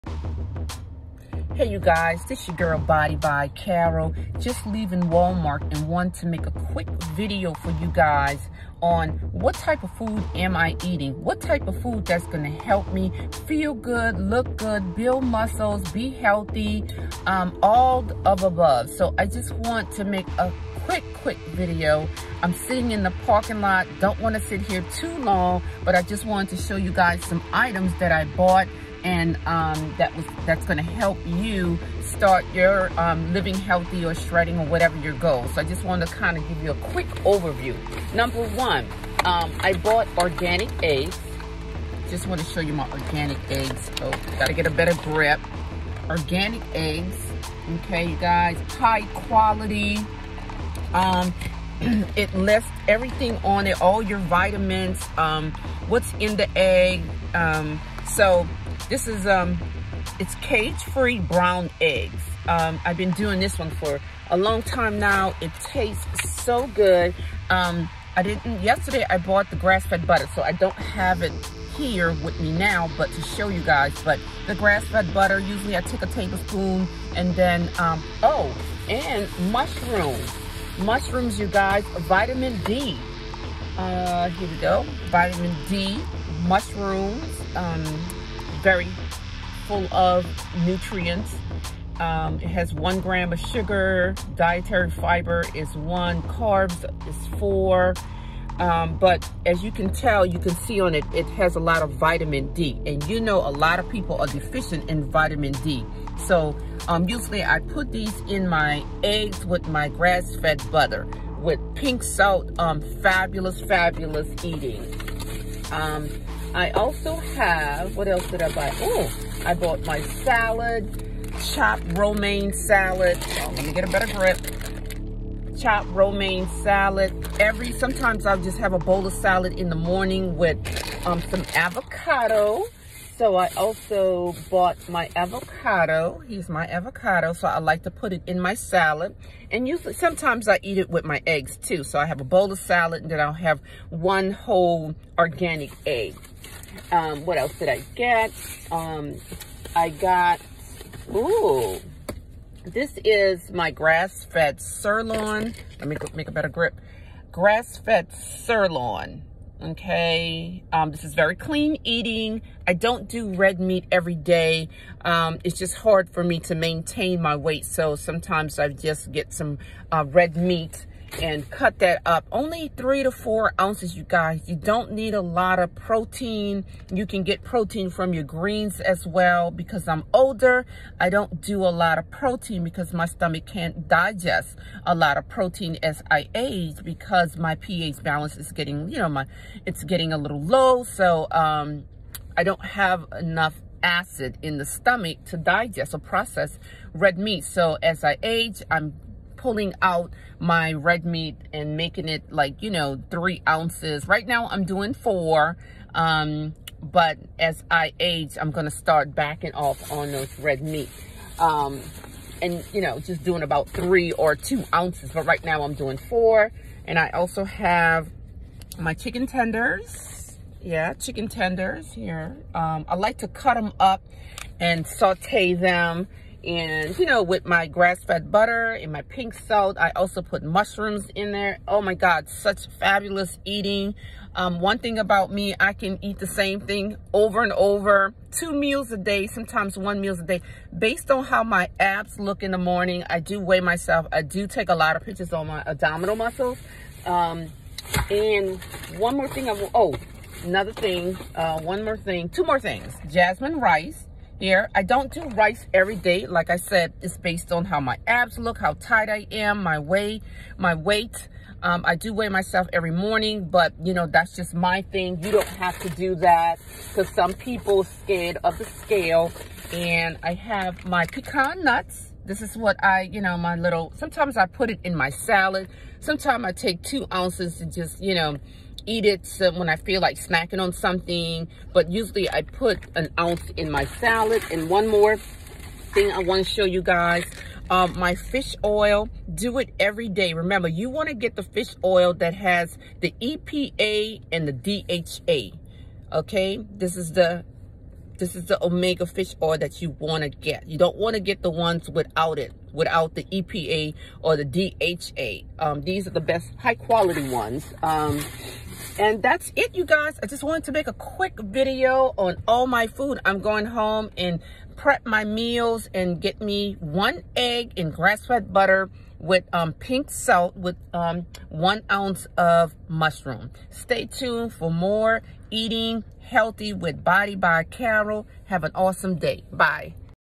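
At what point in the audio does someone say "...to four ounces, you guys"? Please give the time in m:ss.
2:53.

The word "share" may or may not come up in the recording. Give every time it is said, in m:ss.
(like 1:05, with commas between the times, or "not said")
not said.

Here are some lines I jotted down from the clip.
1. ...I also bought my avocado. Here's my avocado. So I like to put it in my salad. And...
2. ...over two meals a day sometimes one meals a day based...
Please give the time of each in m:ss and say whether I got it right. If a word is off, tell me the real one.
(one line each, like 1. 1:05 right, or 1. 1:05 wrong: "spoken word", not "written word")
1. 2:13 right
2. 3:57 right.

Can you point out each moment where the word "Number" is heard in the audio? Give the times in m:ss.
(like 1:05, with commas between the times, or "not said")
0:38.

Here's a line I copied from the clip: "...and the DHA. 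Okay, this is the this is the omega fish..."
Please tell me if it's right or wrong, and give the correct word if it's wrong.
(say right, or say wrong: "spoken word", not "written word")
right.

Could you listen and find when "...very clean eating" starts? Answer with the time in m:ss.
2:41.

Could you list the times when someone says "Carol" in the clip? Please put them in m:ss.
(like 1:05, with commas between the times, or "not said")
0:03, 5:27.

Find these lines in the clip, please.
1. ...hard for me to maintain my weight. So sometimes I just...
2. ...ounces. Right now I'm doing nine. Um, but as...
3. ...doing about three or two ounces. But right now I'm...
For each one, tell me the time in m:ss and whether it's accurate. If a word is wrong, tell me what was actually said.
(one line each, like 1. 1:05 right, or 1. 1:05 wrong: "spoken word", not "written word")
1. 2:45 right
2. 3:23 wrong: "four", not "nine"
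3. 3:33 right.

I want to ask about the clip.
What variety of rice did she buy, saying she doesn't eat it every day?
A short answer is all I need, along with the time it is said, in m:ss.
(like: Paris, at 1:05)
Jasmine, at 4:13.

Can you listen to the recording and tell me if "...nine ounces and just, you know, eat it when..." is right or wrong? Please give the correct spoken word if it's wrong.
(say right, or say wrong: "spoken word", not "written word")
wrong: "two", not "nine".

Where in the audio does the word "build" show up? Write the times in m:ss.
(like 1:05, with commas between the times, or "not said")
0:14.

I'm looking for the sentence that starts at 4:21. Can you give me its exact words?
Um, I do weigh myself every morning, but you know, that's just my thing.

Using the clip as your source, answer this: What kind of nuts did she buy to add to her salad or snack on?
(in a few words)
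Pecan.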